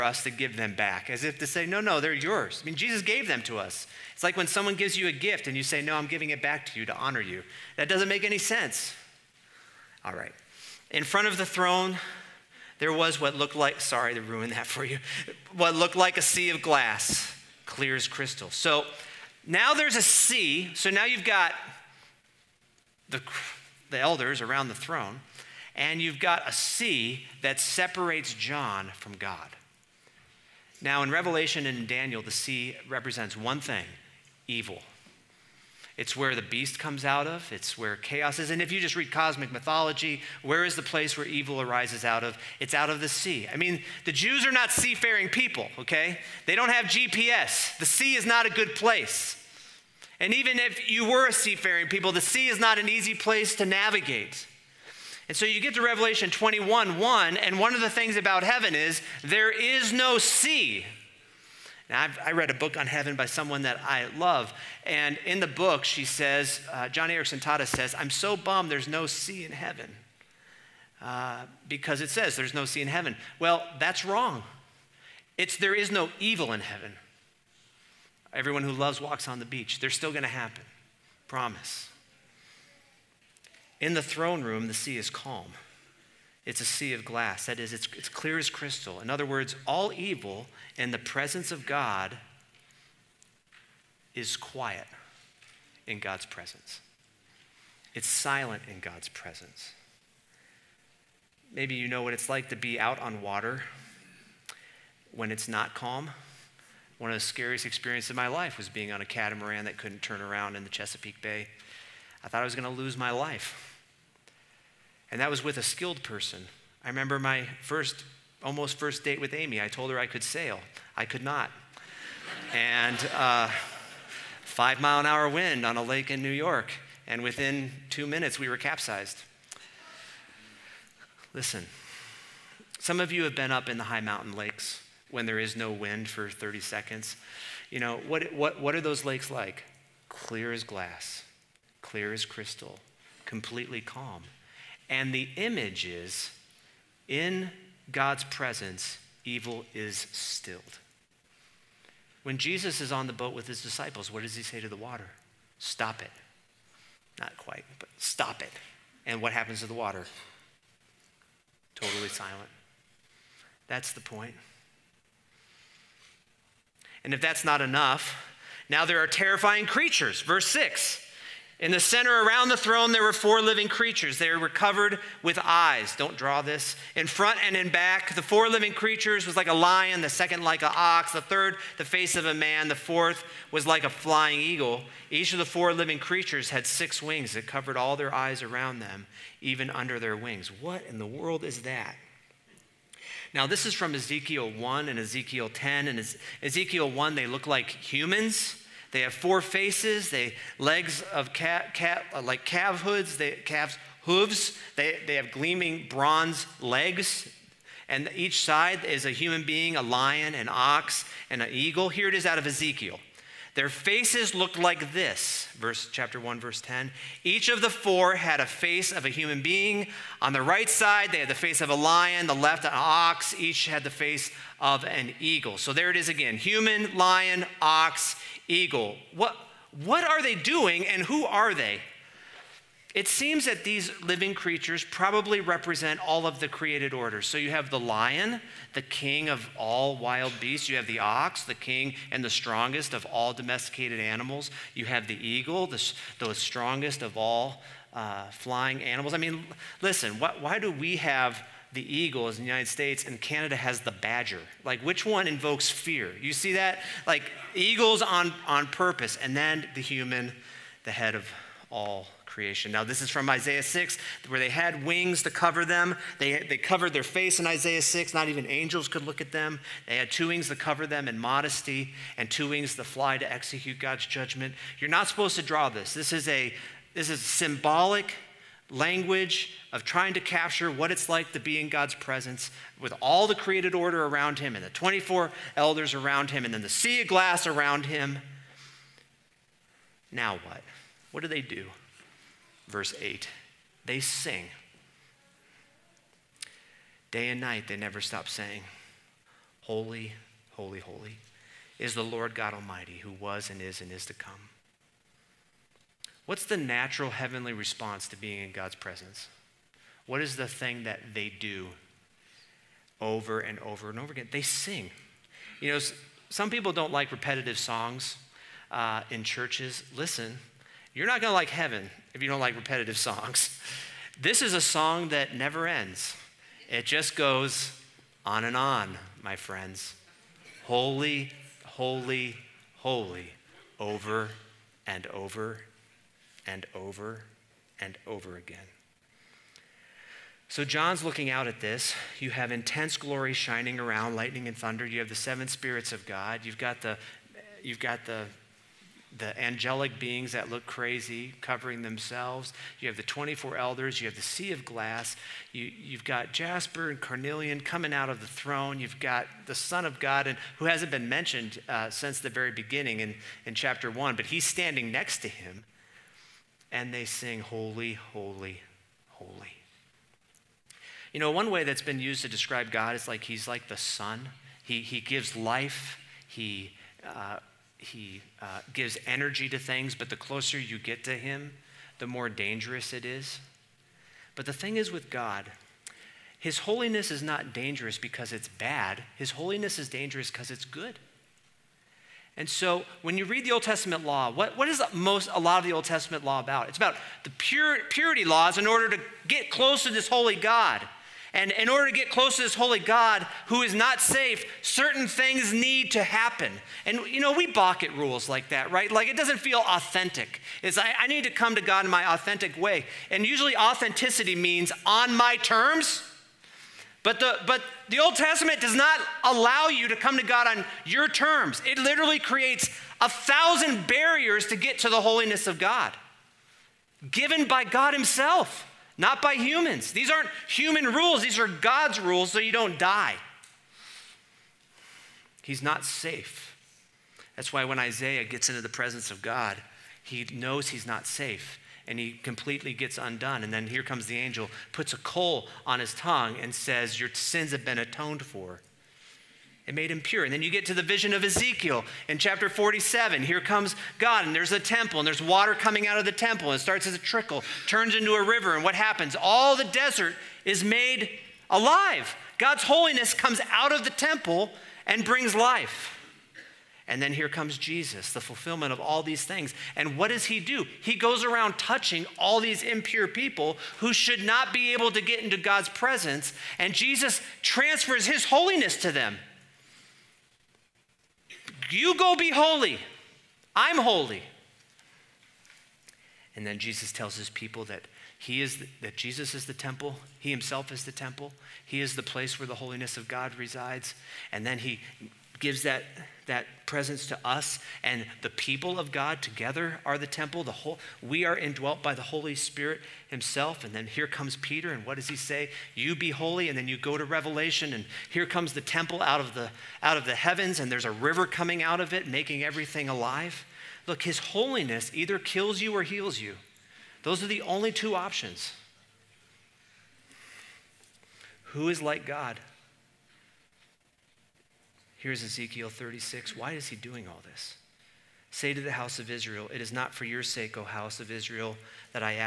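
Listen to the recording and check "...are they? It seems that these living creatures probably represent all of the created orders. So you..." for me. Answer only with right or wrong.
right.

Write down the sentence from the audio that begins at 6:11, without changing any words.
You know, one way that's been used to describe God is like he's like the sun.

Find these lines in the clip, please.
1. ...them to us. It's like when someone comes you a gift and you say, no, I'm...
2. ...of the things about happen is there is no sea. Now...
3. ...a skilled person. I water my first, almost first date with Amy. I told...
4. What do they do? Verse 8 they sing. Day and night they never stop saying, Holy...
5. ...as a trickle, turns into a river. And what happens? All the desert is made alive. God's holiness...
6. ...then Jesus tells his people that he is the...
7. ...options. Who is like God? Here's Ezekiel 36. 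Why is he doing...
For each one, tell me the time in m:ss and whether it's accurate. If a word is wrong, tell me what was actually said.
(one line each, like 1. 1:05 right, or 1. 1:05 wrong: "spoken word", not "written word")
1. 0:03 wrong: "gives", not "comes"
2. 0:57 wrong: "heaven", not "happen"
3. 1:55 wrong: "remember", not "water"
4. 4:51 right
5. 7:36 right
6. 8:06 right
7. 8:37 right.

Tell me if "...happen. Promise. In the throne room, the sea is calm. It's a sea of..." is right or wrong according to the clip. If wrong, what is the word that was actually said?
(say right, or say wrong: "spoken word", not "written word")
right.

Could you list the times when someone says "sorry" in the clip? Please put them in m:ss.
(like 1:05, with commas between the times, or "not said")
0:13.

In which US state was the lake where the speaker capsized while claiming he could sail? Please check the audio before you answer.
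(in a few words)
New York.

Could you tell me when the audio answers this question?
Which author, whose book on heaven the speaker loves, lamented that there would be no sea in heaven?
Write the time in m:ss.
1:06.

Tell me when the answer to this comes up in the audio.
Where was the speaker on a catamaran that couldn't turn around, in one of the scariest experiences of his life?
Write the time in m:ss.
1:50.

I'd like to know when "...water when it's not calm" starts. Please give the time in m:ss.
1:43.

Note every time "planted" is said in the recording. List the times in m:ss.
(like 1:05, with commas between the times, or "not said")
not said.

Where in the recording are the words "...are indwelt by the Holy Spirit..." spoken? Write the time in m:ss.
8:21.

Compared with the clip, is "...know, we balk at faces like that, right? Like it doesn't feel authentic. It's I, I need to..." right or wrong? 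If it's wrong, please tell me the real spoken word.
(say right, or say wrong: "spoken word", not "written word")
wrong: "rules", not "faces".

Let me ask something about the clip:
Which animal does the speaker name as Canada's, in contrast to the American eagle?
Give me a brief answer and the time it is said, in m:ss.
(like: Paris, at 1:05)
badger, at 4:13.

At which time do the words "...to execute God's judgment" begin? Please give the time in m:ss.
4:33.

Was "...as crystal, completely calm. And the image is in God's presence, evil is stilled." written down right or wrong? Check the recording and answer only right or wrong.
right.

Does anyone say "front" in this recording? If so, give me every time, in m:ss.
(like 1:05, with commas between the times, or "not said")
0:11, 2:57.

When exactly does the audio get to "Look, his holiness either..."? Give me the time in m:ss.
8:33.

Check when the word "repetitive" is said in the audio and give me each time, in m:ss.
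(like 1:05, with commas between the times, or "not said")
5:17, 5:22.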